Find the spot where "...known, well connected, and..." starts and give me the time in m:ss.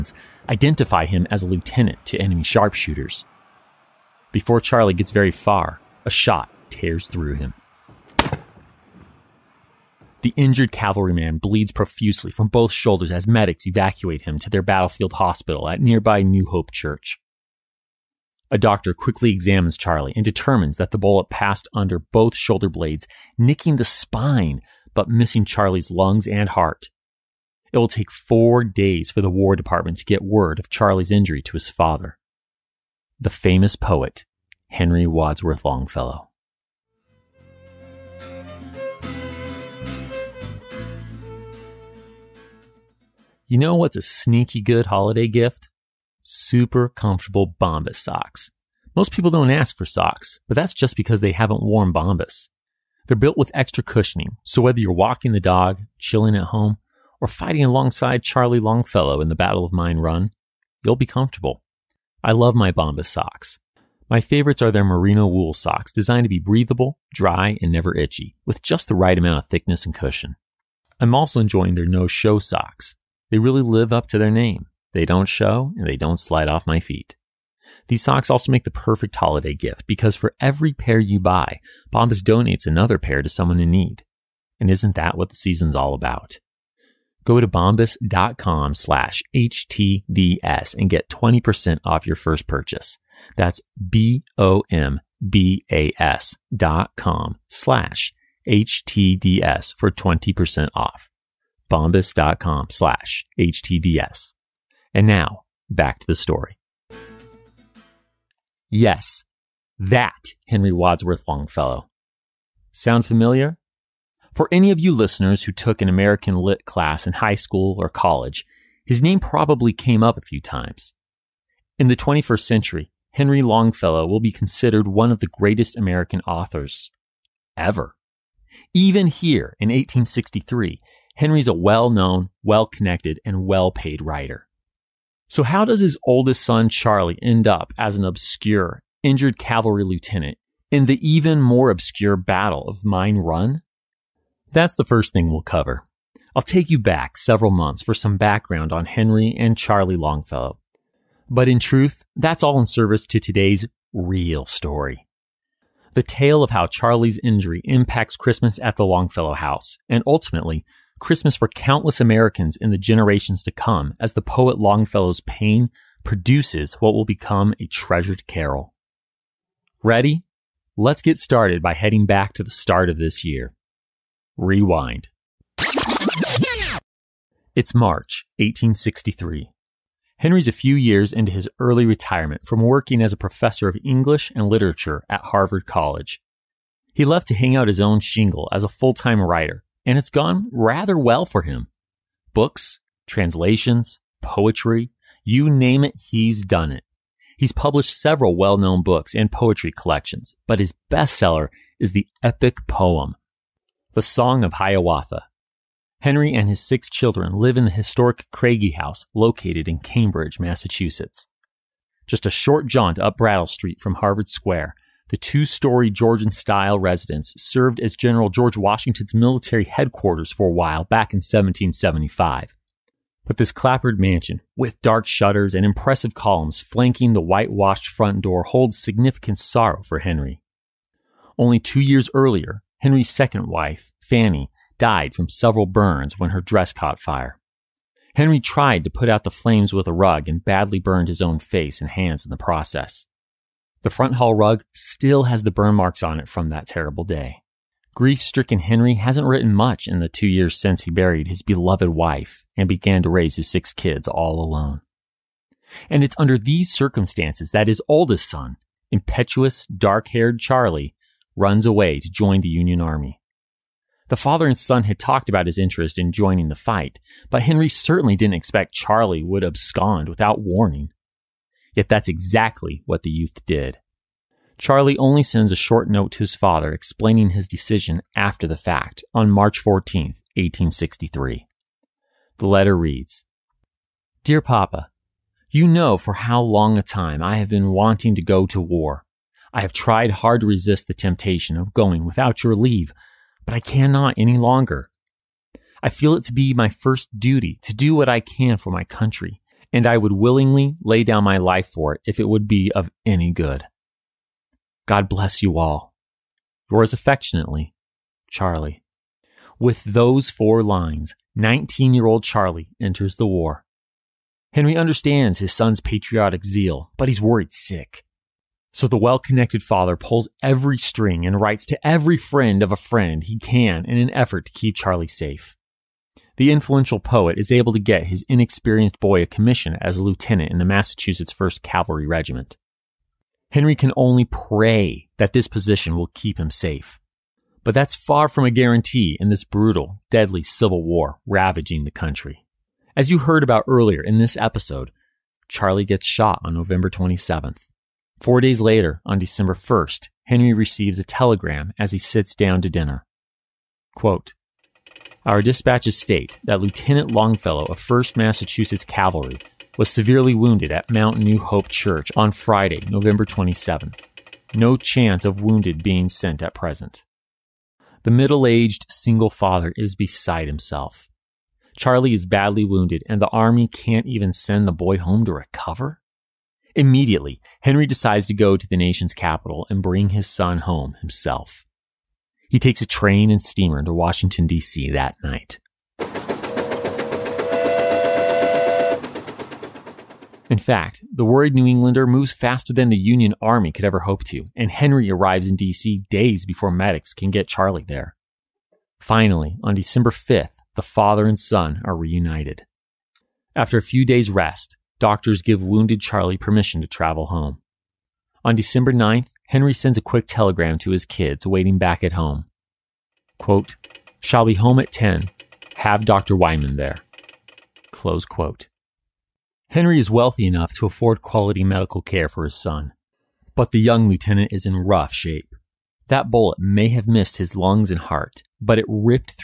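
2:11.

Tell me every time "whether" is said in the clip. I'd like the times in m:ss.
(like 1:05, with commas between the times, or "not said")
0:54.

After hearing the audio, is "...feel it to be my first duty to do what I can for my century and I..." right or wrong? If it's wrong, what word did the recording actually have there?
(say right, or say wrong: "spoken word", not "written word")
wrong: "country", not "century".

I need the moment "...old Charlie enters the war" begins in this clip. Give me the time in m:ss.
5:12.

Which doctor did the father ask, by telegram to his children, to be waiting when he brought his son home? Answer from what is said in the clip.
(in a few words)
Dr. Wyman.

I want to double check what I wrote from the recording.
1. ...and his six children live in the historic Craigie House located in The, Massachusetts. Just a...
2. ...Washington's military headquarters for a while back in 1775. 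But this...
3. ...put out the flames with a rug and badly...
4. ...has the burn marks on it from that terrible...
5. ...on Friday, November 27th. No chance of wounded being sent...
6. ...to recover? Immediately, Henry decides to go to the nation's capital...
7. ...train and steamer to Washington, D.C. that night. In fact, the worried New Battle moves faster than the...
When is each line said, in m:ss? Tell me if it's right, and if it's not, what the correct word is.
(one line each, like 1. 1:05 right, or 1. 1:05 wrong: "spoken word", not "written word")
1. 3:26 wrong: "Cambridge", not "The"
2. 3:38 right
3. 3:58 right
4. 4:05 right
5. 6:02 right
6. 6:15 right
7. 6:22 wrong: "Englander", not "Battle".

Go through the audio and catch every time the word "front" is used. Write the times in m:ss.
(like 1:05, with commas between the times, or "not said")
3:47, 4:03.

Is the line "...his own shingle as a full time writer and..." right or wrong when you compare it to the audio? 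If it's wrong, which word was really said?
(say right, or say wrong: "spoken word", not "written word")
right.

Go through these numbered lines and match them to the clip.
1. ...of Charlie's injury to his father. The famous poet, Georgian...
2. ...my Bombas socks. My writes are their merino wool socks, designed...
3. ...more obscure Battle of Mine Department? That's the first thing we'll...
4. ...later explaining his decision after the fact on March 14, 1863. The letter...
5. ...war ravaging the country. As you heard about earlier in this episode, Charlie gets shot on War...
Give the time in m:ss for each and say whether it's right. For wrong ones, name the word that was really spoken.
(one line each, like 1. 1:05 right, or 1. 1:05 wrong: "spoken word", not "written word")
1. 0:30 wrong: "Henry", not "Georgian"
2. 1:02 wrong: "favorites", not "writes"
3. 2:21 wrong: "Run", not "Department"
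4. 4:36 wrong: "father", not "later"
5. 5:40 wrong: "November", not "War".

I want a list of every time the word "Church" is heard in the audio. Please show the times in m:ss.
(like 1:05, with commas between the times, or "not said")
0:16, 6:01.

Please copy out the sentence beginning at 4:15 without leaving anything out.
And it's under these circumstances that his oldest son, impetuous, dark haired Charlie, runs away to join the Union Army.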